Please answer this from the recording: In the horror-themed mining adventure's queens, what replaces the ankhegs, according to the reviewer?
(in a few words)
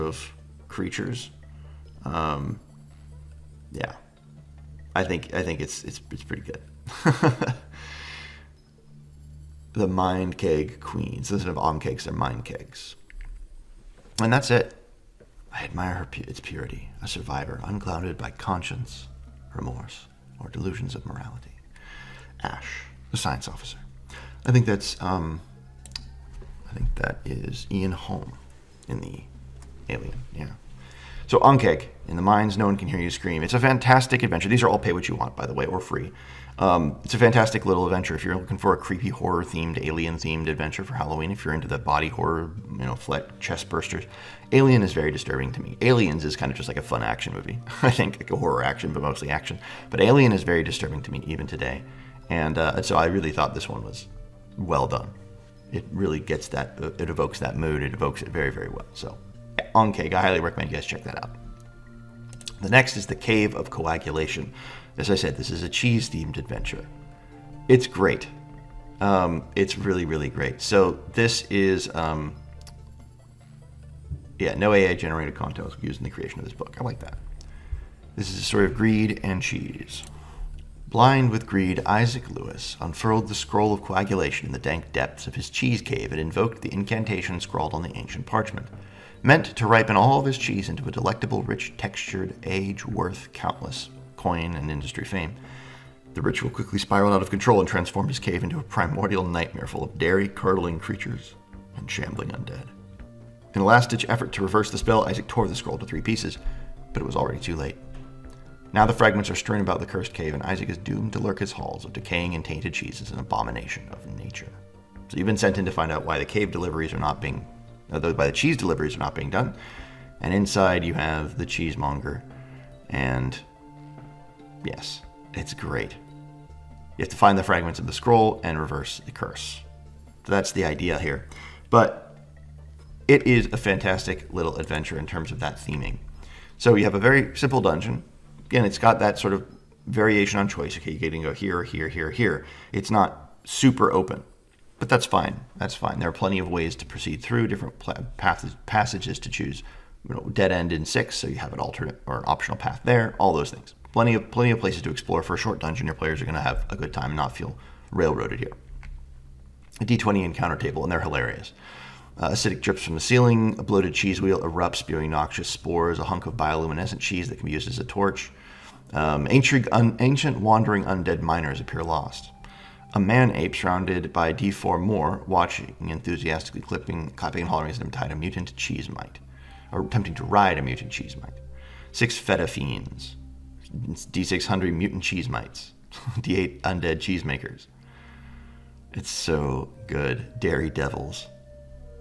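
Mind kegs.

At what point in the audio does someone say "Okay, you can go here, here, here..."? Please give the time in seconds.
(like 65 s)
140 s.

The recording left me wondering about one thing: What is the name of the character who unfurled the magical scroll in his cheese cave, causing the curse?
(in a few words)
Isaac Lewis.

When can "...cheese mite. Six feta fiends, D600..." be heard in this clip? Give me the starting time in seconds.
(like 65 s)
180 s.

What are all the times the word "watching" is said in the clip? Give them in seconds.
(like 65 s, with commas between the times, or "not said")
175 s.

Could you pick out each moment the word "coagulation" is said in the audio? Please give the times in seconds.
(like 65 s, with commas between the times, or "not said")
63 s, 83 s.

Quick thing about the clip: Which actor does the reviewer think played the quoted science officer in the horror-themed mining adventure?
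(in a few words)
Ian Holm.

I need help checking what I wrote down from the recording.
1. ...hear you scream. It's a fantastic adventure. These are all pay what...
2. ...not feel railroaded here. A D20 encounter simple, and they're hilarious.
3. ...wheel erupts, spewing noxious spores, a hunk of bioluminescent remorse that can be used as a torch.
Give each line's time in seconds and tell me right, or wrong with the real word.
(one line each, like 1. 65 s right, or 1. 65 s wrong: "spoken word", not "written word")
1. 32 s right
2. 157 s wrong: "table", not "simple"
3. 164 s wrong: "cheese", not "remorse".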